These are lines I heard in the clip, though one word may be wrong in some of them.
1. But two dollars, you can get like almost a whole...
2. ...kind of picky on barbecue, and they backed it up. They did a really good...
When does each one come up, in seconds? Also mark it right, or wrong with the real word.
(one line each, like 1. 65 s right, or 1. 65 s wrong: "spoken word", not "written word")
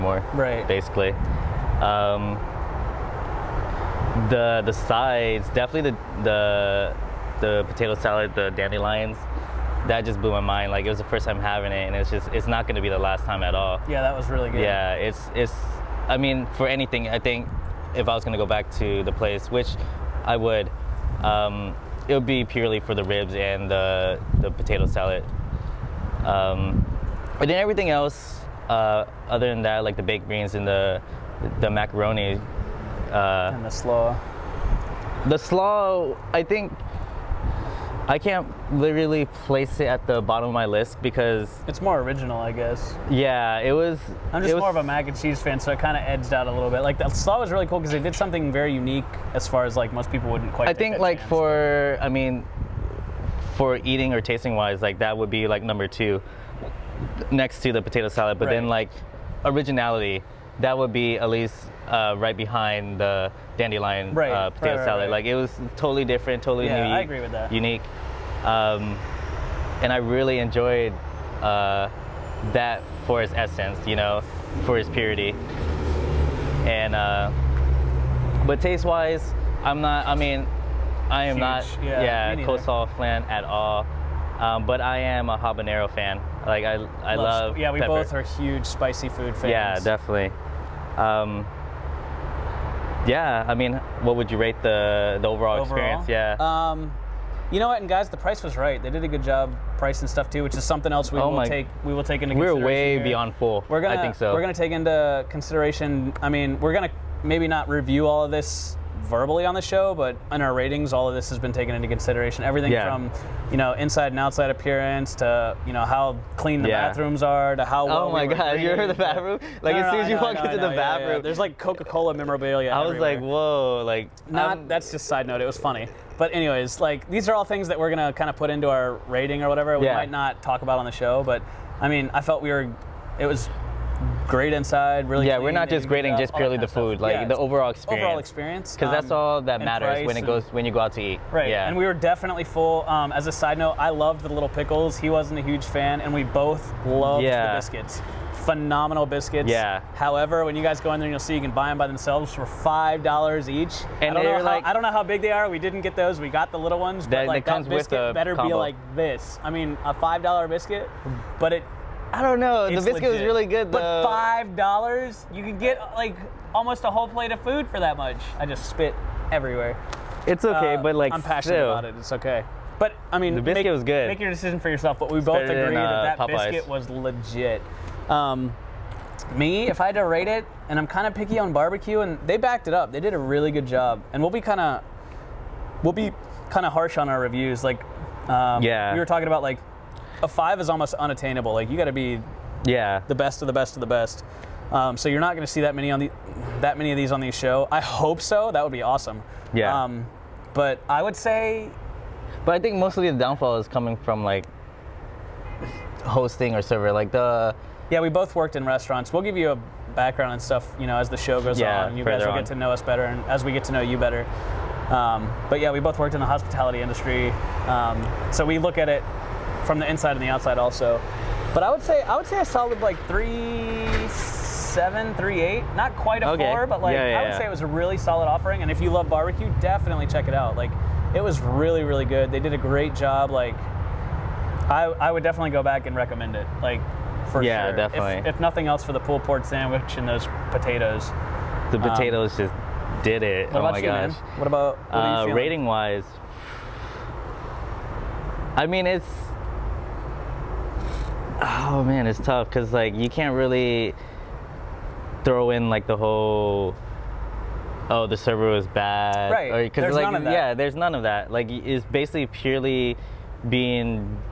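1. 164 s wrong: "five", not "two"
2. 180 s right.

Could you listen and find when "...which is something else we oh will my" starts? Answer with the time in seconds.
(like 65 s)
100 s.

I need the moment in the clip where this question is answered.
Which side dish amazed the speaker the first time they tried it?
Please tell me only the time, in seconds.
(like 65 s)
8 s.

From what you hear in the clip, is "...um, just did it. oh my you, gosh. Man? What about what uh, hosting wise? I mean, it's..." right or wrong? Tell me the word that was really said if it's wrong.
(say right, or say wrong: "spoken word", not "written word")
wrong: "rating", not "hosting".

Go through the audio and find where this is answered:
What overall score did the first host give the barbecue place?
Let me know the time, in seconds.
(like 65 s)
223 s.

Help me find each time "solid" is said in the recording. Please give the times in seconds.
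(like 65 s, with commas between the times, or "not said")
222 s, 227 s.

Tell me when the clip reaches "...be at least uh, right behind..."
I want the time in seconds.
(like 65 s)
60 s.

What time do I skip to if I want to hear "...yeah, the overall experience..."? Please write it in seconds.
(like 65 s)
137 s.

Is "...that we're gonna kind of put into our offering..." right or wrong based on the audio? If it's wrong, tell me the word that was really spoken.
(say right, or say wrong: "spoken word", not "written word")
wrong: "rating", not "offering".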